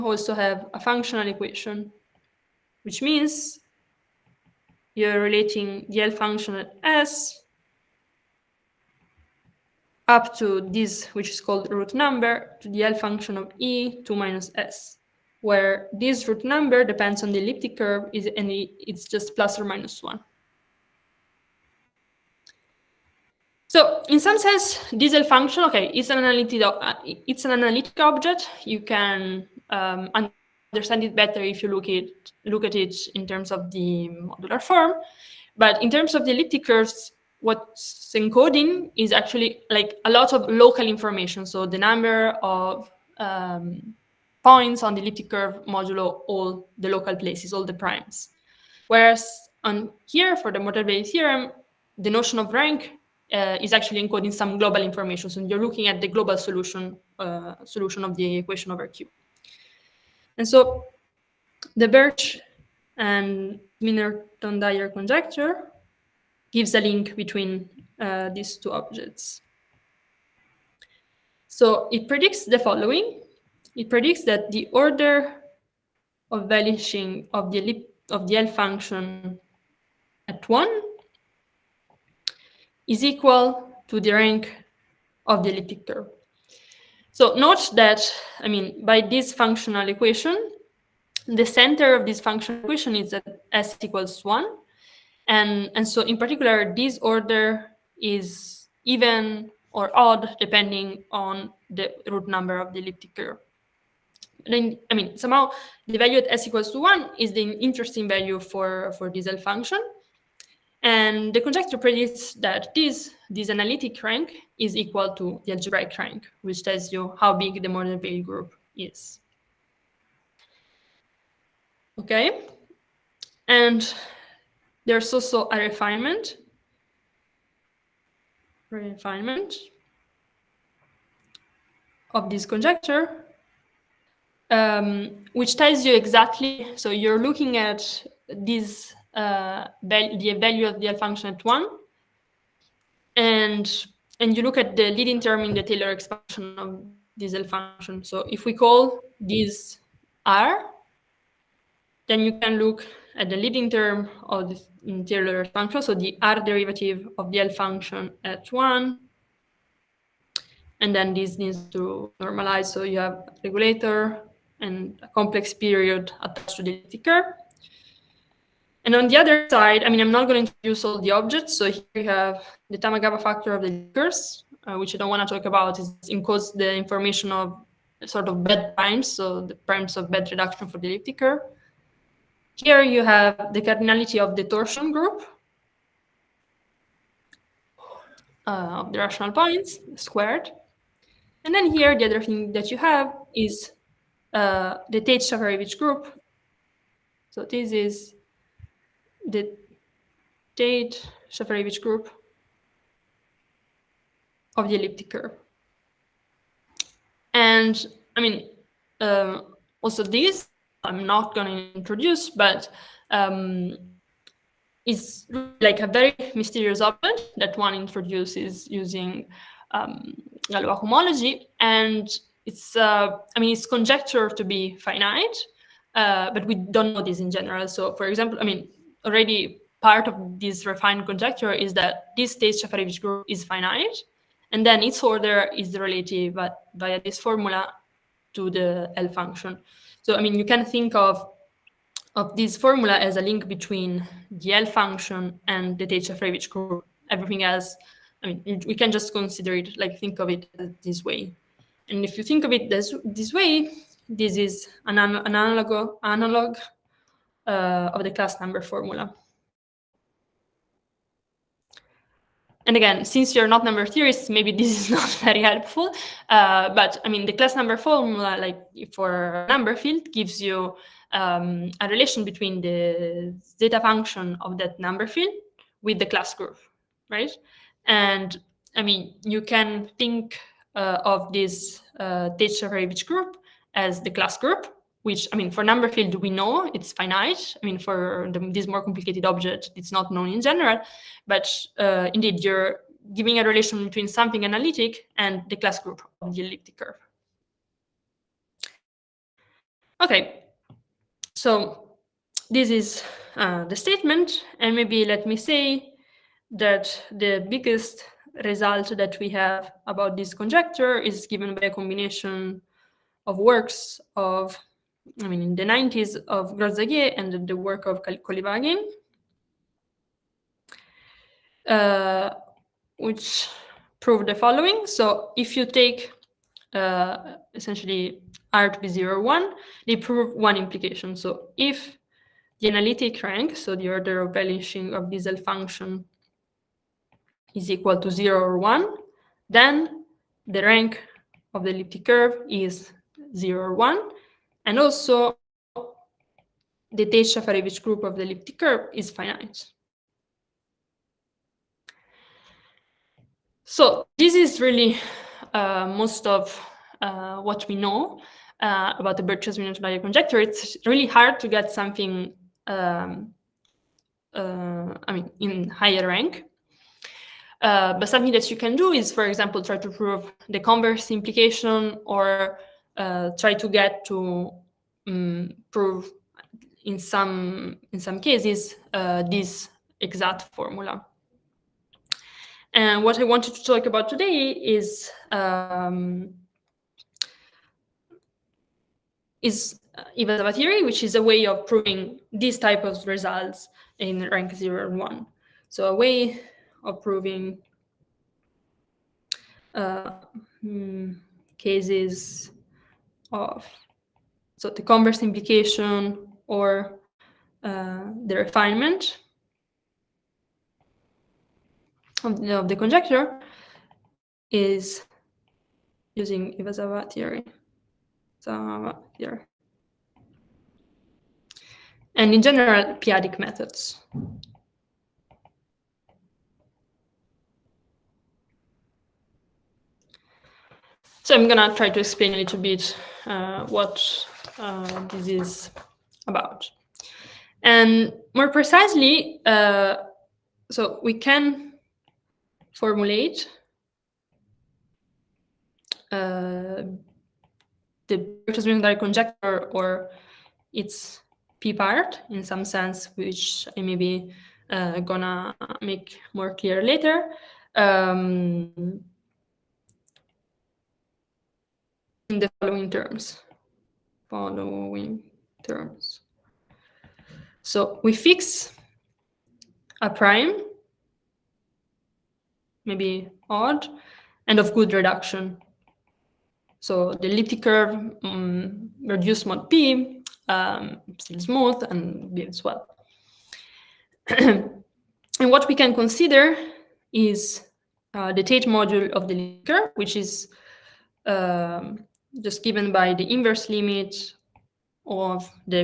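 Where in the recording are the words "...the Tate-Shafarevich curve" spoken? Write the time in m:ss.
4:05.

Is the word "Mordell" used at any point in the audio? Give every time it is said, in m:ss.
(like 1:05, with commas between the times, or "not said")
0:50, 1:57.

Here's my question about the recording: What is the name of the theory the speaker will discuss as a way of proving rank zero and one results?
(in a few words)
Iwasawa theory.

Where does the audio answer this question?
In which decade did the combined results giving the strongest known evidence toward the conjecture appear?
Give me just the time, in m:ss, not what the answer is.
5:15.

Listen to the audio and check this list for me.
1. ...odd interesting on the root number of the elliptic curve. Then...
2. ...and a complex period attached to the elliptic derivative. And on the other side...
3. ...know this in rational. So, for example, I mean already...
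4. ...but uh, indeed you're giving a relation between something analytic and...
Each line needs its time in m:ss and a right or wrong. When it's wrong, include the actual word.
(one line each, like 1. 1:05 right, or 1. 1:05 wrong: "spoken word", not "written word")
1. 1:39 wrong: "depending", not "interesting"
2. 2:44 wrong: "curve", not "derivative"
3. 3:46 wrong: "general", not "rational"
4. 4:51 right.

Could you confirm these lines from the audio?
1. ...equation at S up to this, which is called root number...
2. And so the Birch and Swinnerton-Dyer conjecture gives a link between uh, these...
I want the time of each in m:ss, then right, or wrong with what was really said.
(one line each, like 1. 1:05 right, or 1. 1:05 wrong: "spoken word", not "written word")
1. 0:06 wrong: "function", not "equation"
2. 1:00 right.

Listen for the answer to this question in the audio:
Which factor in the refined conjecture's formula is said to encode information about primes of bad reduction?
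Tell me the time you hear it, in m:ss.
2:52.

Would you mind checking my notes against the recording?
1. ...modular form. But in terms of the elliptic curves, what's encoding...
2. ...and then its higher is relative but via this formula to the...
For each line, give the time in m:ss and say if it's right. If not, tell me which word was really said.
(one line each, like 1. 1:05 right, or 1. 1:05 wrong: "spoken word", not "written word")
1. 0:34 right
2. 3:54 wrong: "order", not "higher".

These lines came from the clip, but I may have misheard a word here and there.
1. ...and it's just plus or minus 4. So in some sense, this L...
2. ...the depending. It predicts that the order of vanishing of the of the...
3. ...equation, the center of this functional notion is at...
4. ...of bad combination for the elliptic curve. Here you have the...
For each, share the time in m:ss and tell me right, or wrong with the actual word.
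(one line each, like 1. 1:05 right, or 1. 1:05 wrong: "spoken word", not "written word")
1. 0:18 wrong: "1", not "4"
2. 1:12 wrong: "following", not "depending"
3. 1:29 wrong: "equation", not "notion"
4. 2:59 wrong: "reduction", not "combination".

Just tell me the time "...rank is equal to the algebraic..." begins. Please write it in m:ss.
1:54.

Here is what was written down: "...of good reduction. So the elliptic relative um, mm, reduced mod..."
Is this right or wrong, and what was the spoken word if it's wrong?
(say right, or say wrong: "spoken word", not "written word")
wrong: "curve", not "relative".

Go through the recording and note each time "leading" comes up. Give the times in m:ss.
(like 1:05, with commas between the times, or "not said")
2:24, 2:33.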